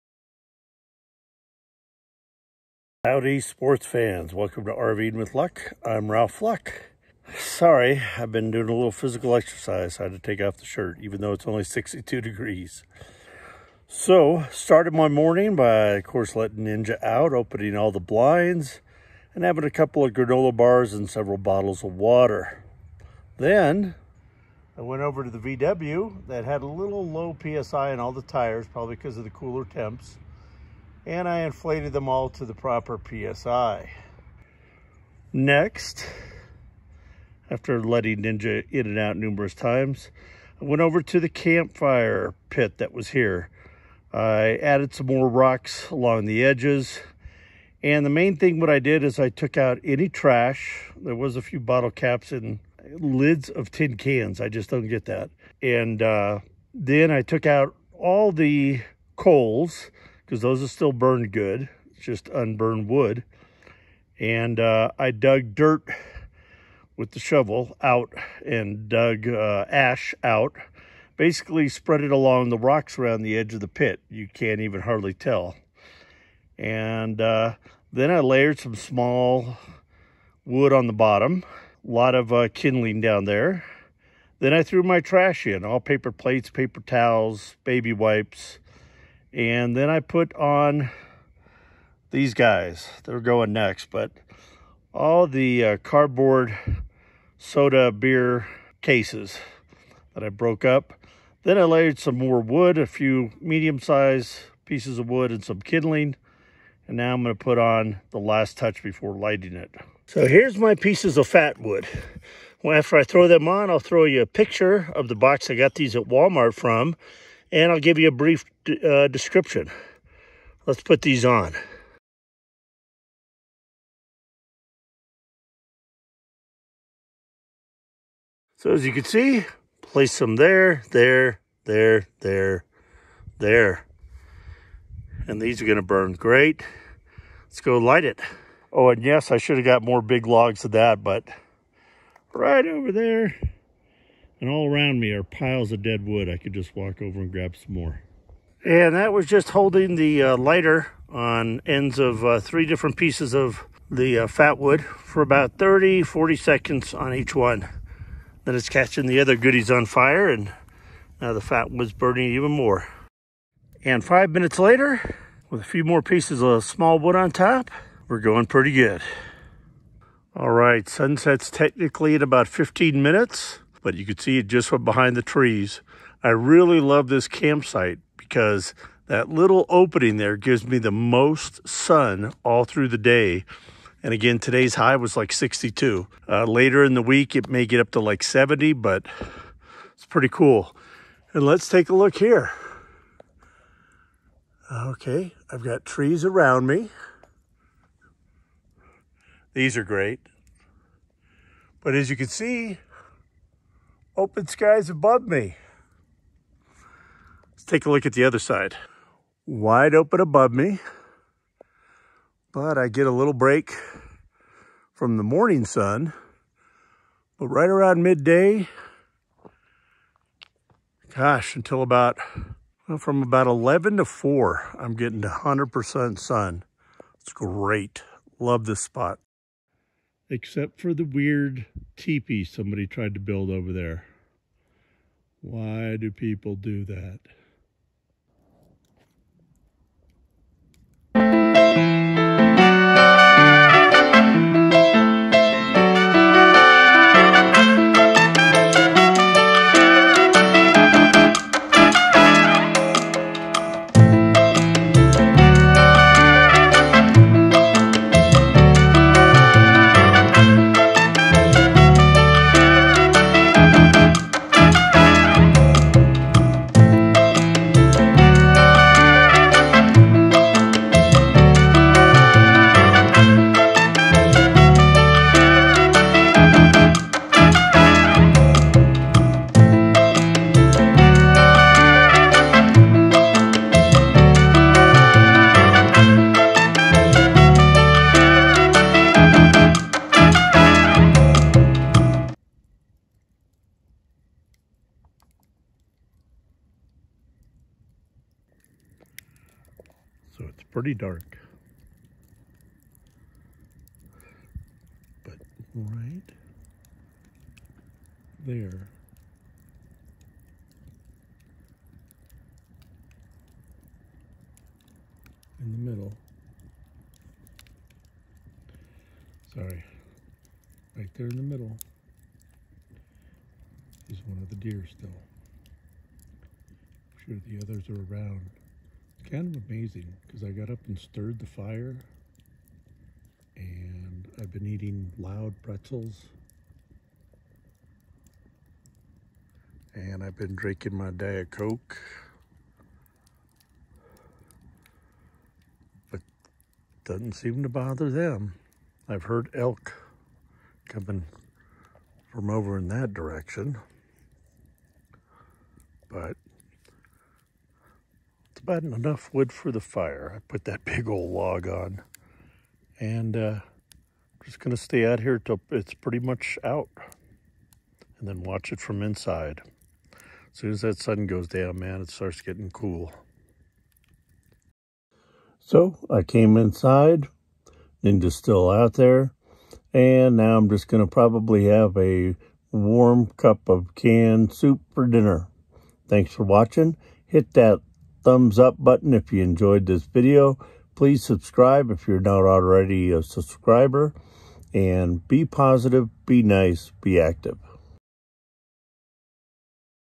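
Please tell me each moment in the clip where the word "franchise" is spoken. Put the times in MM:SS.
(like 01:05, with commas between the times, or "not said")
not said.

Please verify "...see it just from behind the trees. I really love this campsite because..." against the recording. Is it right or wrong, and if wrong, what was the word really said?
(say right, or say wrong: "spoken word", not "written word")
right.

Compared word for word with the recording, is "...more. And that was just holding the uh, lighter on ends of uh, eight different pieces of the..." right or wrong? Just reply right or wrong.
wrong.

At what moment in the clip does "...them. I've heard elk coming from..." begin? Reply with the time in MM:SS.
05:48.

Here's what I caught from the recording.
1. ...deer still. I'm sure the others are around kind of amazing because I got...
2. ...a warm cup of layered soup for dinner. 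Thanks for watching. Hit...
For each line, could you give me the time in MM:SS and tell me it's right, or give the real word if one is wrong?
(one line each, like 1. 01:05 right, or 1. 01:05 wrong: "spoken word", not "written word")
1. 05:24 right
2. 06:21 wrong: "canned", not "layered".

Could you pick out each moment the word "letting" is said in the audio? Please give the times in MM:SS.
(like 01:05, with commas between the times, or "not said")
00:16, 00:37.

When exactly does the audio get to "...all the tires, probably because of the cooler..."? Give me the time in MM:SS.
00:27.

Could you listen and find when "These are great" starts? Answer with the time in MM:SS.
03:19.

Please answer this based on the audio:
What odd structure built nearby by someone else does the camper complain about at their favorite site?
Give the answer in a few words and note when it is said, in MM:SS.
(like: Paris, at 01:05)
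teepee, at 03:51.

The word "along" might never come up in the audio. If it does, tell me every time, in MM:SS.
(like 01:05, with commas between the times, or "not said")
00:45, 01:12.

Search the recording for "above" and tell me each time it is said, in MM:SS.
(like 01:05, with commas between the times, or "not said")
03:24, 03:30.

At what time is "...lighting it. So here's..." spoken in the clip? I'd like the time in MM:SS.
01:49.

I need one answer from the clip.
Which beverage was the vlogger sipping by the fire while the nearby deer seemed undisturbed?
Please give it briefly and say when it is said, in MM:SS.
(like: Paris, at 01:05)
Diet Coke, at 05:41.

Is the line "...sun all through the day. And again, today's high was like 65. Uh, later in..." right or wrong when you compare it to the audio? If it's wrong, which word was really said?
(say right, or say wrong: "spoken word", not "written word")
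wrong: "62", not "65".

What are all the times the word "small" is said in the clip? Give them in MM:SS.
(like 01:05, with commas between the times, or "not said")
01:18, 02:46.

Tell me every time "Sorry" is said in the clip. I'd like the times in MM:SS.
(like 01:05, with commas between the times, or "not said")
00:07, 05:19.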